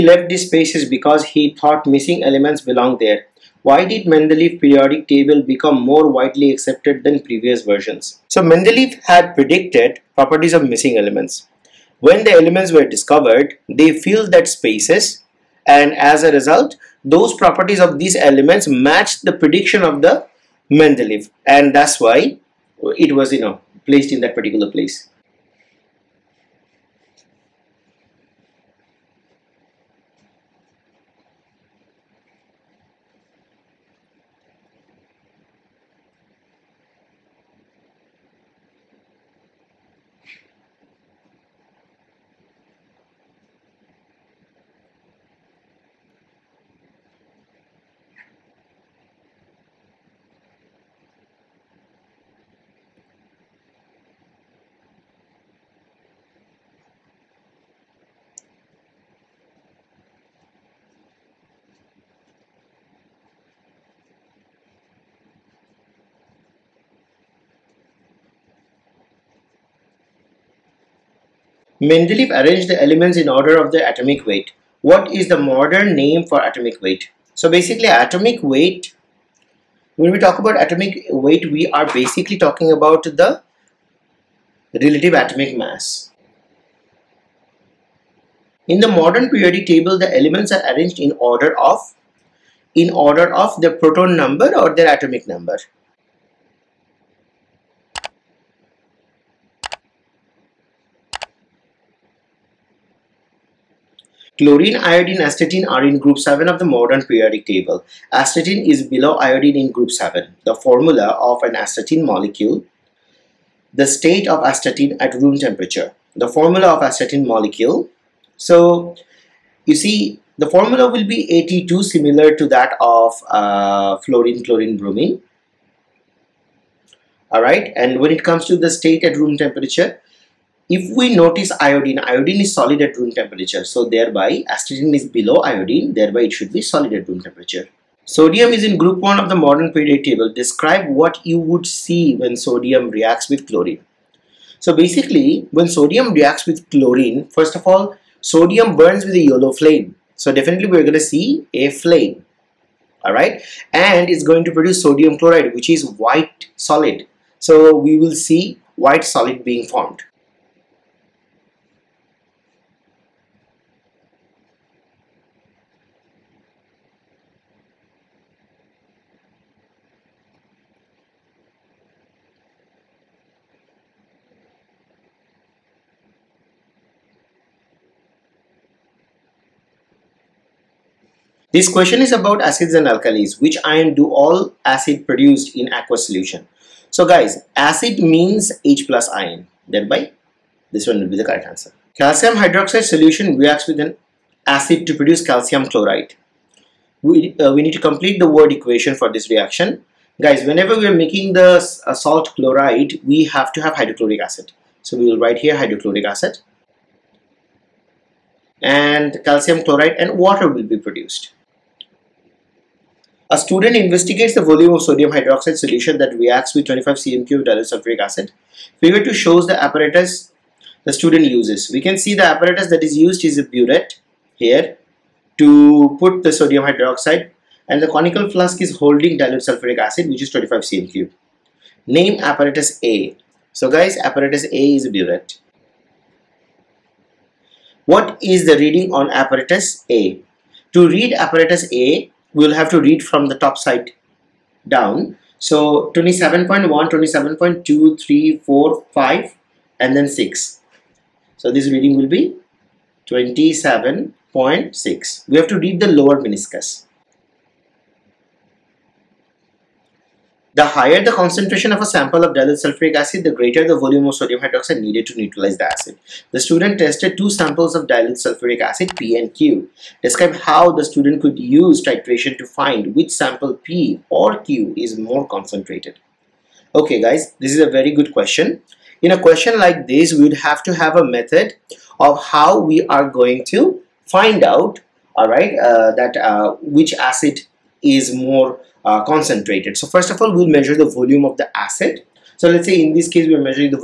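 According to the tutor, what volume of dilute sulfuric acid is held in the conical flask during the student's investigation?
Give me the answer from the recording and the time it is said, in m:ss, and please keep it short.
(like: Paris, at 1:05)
25 cm cube, at 3:50.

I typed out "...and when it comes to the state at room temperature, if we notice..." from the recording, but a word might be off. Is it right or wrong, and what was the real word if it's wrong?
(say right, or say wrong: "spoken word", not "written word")
right.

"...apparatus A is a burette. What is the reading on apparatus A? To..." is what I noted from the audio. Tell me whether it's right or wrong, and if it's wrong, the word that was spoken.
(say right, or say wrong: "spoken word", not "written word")
right.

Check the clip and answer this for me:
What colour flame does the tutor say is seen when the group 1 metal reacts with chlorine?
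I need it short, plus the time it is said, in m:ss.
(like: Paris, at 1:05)
yellow, at 2:29.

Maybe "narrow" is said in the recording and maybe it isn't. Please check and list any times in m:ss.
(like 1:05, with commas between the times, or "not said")
not said.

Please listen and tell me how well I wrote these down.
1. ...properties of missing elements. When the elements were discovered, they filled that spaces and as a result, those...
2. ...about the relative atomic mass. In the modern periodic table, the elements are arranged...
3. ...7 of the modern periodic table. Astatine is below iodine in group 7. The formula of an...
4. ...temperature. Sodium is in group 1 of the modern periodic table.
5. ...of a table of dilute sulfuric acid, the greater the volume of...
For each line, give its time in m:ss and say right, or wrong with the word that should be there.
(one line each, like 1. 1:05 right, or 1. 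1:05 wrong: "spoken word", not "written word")
1. 0:10 right
2. 1:22 right
3. 1:46 right
4. 2:17 right
5. 4:21 wrong: "sample", not "table".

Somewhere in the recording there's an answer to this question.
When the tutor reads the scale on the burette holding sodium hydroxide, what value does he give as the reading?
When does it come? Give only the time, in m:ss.
4:13.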